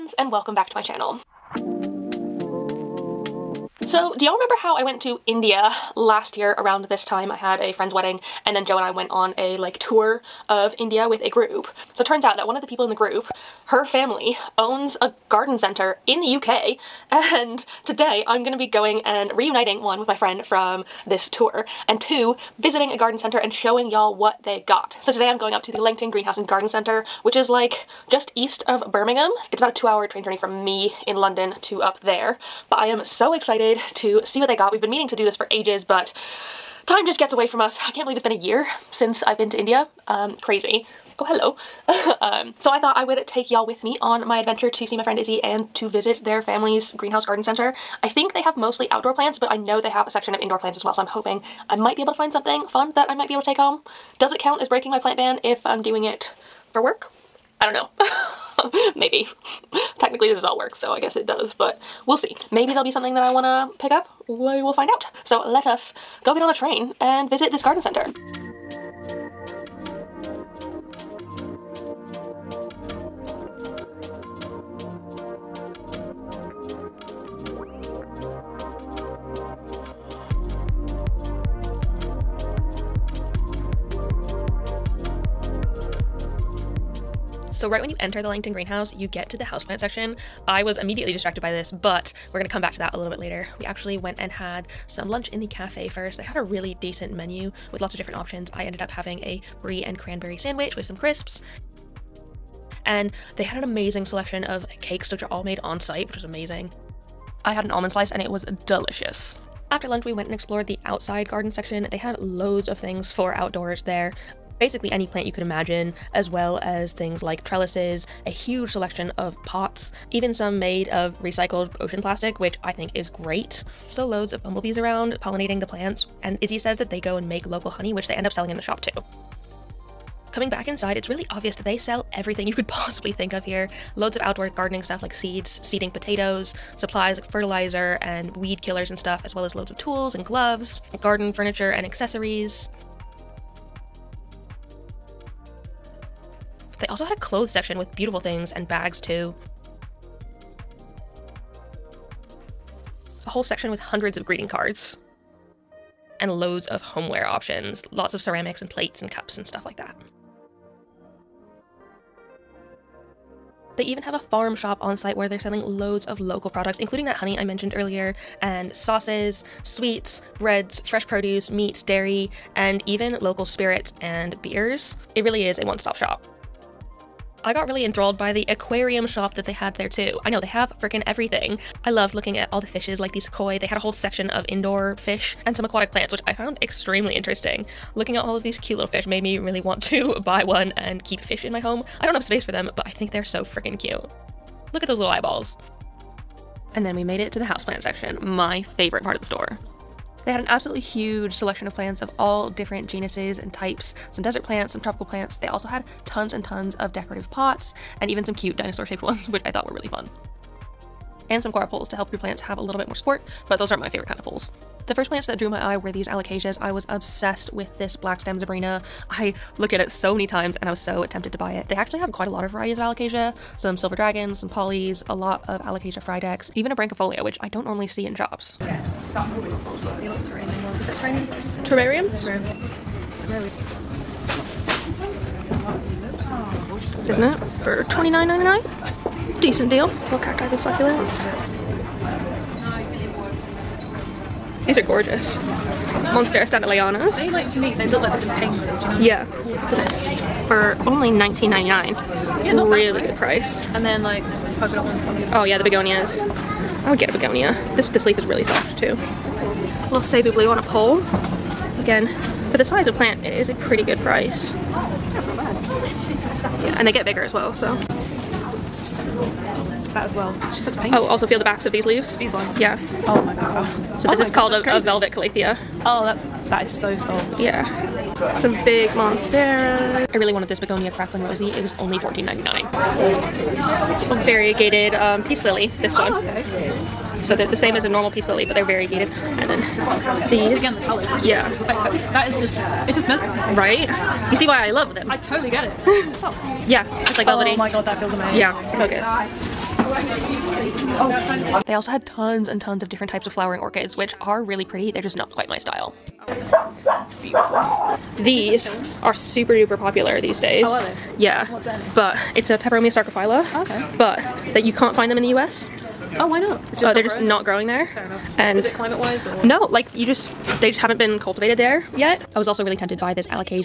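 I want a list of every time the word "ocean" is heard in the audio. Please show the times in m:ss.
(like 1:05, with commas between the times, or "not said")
2:01.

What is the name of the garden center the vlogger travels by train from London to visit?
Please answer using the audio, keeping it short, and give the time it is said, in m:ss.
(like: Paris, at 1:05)
Langton Greenhouse and Garden Center, at 0:25.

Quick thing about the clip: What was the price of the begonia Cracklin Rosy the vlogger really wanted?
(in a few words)
$14.99.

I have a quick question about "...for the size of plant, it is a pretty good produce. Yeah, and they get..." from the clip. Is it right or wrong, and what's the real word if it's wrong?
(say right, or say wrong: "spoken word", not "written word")
wrong: "price", not "produce".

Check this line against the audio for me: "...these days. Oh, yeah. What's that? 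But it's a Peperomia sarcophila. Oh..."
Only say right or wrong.
right.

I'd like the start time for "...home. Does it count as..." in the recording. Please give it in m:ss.
0:53.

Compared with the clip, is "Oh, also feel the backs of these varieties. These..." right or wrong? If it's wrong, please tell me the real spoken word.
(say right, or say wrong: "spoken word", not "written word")
wrong: "leaves", not "varieties".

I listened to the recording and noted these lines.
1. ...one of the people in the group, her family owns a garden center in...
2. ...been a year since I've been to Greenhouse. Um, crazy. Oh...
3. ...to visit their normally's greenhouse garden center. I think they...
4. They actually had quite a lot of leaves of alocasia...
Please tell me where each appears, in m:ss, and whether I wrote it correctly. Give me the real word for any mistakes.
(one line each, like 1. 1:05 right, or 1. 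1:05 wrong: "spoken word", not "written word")
1. 0:12 right
2. 0:38 wrong: "India", not "Greenhouse"
3. 0:45 wrong: "family", not "normally"
4. 3:41 wrong: "varieties", not "leaves".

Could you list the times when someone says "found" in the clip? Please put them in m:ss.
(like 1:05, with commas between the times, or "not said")
3:06.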